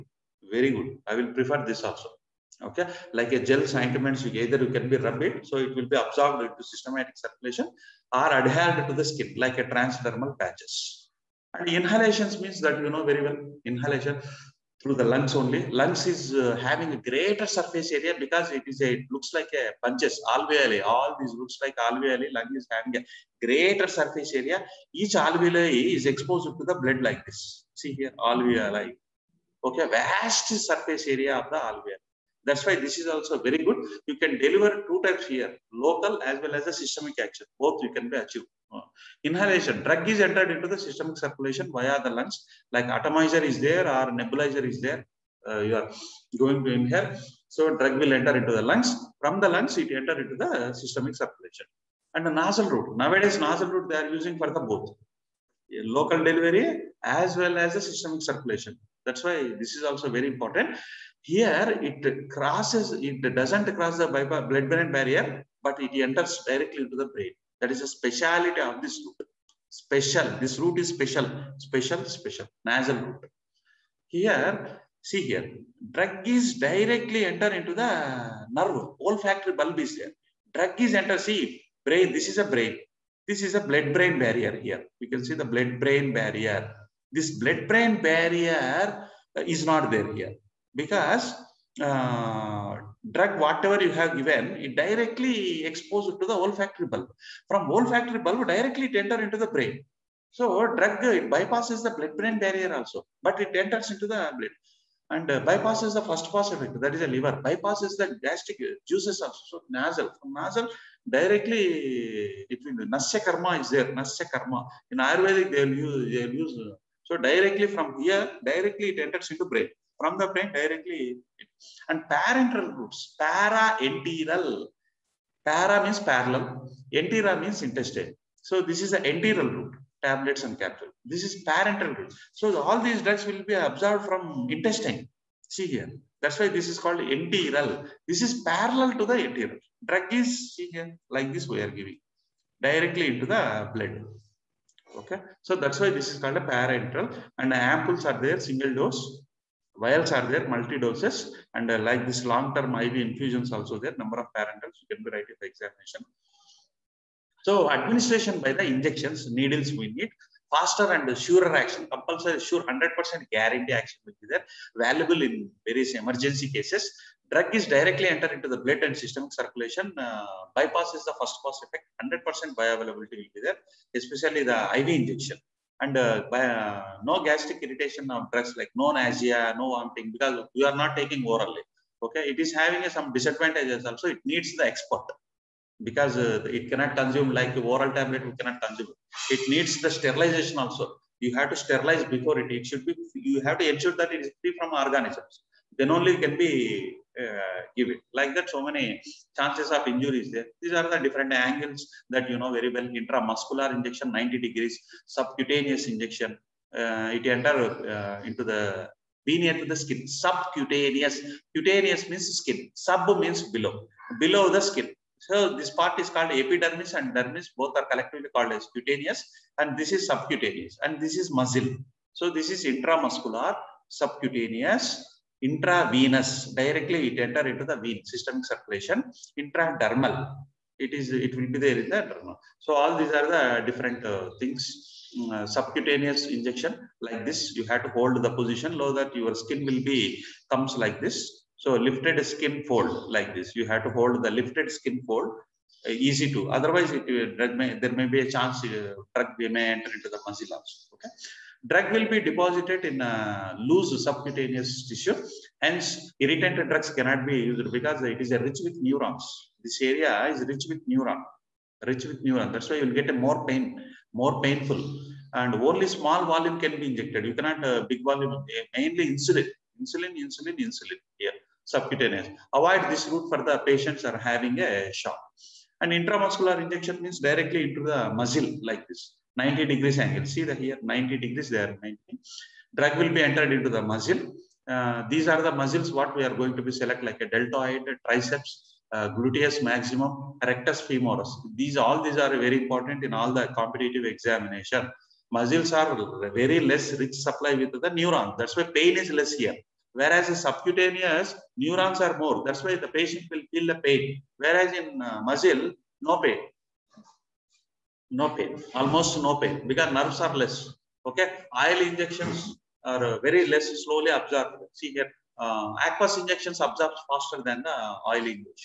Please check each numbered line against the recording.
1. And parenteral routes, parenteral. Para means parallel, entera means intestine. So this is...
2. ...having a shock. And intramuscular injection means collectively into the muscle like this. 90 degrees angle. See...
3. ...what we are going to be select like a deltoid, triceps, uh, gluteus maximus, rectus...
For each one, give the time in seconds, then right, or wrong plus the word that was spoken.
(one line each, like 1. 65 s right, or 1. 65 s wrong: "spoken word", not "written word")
1. 121 s right
2. 274 s wrong: "directly", not "collectively"
3. 285 s right.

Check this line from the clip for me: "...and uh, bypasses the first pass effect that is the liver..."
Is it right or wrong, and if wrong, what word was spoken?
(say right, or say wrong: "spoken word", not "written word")
right.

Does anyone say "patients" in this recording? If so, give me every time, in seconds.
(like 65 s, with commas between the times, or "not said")
273 s, 302 s.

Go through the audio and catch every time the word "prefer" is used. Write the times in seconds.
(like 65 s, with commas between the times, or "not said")
1 s.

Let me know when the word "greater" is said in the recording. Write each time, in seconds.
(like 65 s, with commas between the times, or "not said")
16 s, 23 s.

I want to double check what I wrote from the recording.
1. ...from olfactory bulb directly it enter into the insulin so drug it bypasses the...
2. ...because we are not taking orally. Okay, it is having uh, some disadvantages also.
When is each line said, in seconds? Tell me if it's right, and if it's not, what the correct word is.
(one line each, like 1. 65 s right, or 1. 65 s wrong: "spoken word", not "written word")
1. 97 s wrong: "brain", not "insulin"
2. 180 s right.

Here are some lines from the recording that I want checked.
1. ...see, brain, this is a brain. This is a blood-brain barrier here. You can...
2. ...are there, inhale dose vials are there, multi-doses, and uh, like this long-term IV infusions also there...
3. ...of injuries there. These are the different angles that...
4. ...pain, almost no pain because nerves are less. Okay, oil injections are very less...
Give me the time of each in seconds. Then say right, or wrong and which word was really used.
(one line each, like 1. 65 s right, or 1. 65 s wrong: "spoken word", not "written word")
1. 81 s right
2. 148 s wrong: "single", not "inhale"
3. 199 s right
4. 308 s right.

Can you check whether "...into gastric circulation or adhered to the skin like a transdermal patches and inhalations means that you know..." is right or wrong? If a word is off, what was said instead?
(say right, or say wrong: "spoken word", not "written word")
wrong: "systematic", not "gastric".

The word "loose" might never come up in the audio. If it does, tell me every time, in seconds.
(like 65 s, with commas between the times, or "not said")
253 s.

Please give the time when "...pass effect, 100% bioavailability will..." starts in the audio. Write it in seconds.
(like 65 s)
171 s.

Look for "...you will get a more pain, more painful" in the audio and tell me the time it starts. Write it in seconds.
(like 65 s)
262 s.